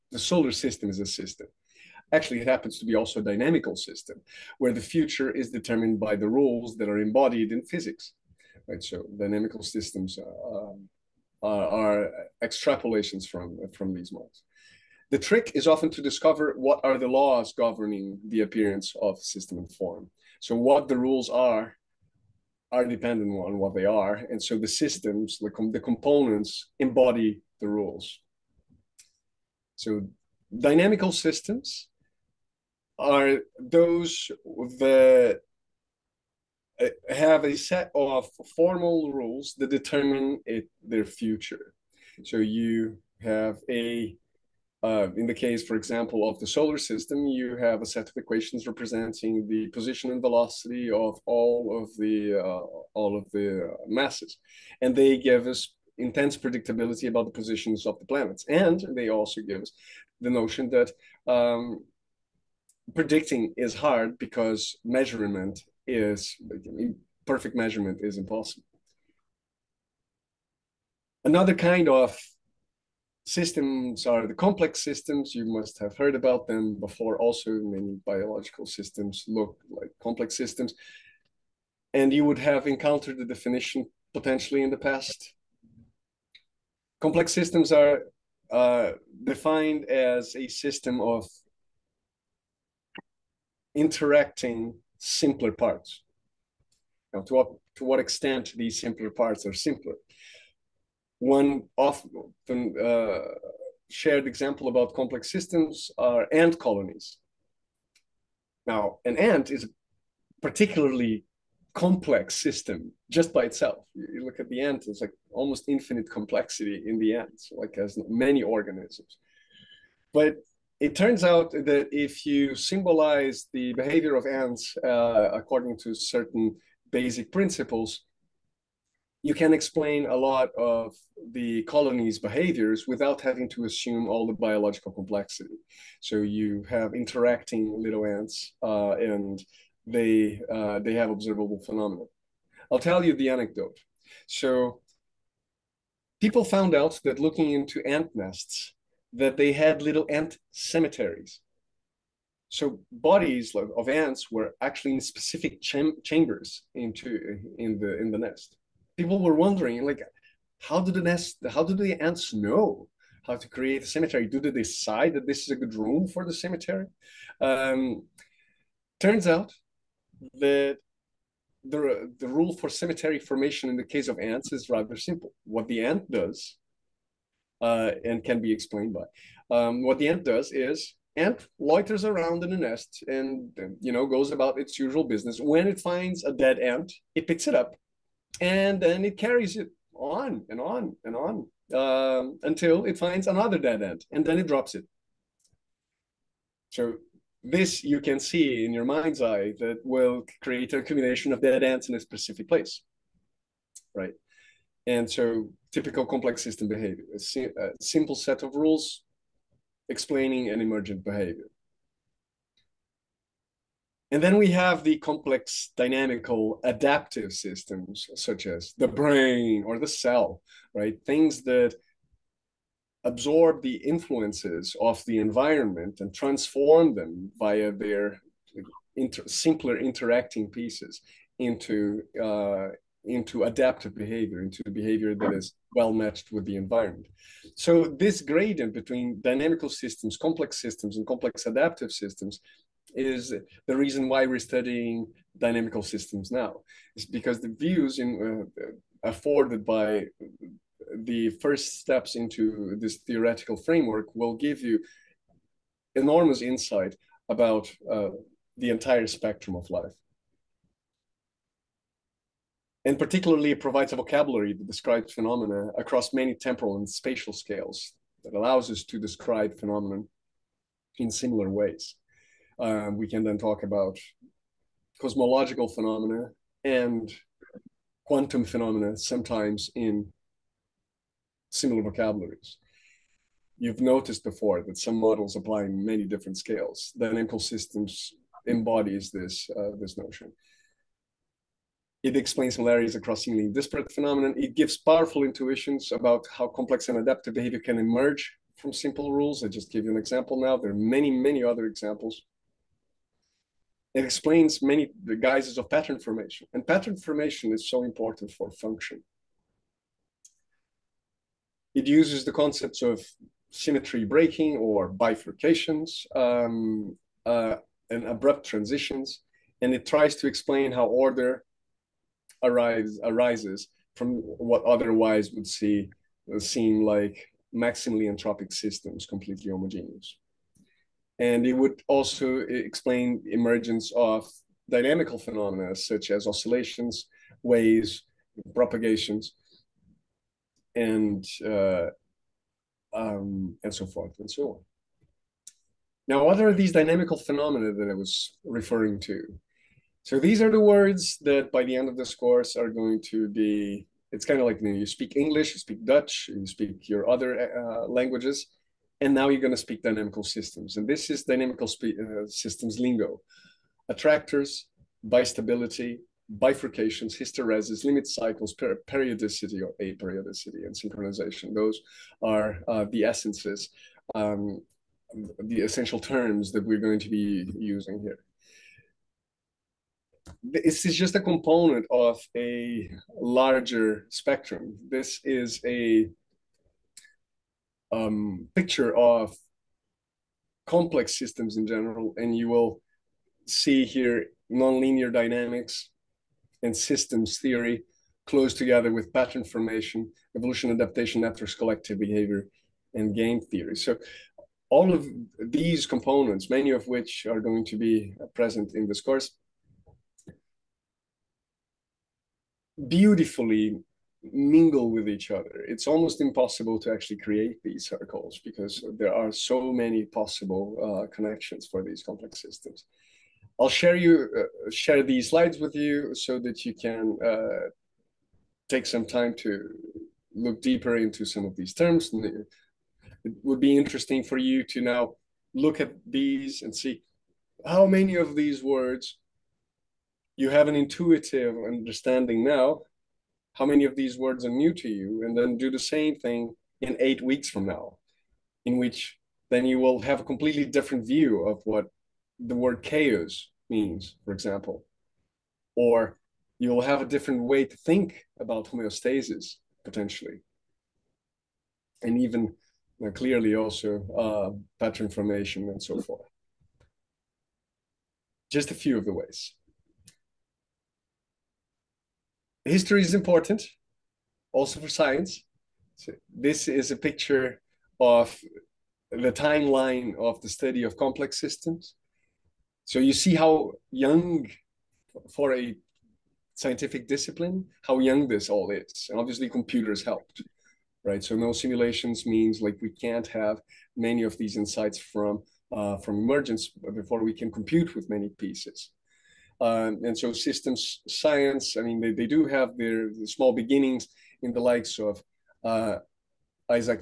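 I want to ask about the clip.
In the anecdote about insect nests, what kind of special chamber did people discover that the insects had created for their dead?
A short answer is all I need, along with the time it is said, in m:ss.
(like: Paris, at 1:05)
cemeteries, at 2:30.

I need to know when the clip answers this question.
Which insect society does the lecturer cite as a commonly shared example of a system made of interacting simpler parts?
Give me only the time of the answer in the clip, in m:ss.
1:46.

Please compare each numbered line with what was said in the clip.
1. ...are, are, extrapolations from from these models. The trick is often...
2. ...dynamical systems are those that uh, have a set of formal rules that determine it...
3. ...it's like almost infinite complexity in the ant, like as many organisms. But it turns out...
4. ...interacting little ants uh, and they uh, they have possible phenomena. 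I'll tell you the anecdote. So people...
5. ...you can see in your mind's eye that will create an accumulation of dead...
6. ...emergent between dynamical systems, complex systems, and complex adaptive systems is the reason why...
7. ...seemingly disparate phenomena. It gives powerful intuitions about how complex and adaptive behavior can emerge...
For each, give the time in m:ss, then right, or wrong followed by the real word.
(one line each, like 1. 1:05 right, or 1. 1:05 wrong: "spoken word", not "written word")
1. 0:11 right
2. 0:30 right
3. 1:54 right
4. 2:16 wrong: "observable", not "possible"
5. 3:17 right
6. 3:58 wrong: "gradient", not "emergent"
7. 4:53 right.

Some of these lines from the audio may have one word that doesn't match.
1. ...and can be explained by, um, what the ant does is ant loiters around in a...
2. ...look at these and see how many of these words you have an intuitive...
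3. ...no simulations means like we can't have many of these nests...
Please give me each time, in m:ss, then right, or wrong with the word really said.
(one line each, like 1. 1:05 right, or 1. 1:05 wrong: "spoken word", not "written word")
1. 2:58 right
2. 7:15 right
3. 8:11 wrong: "insights", not "nests".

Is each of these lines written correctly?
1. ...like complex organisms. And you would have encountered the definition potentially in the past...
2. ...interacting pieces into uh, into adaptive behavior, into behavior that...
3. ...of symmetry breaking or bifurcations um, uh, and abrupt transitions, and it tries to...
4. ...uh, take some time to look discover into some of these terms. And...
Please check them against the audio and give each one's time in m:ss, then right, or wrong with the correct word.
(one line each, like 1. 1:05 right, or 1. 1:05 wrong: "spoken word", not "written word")
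1. 1:19 wrong: "systems", not "organisms"
2. 3:49 right
3. 5:12 right
4. 7:07 wrong: "deeper", not "discover".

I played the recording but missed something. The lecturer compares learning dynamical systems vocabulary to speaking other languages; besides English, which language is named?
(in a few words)
Dutch.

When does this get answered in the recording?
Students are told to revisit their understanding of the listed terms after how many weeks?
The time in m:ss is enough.
7:26.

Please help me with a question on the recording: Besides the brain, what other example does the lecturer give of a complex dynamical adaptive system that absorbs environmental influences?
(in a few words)
the cell.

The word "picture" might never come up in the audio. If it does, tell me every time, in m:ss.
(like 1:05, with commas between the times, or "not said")
6:28, 7:56.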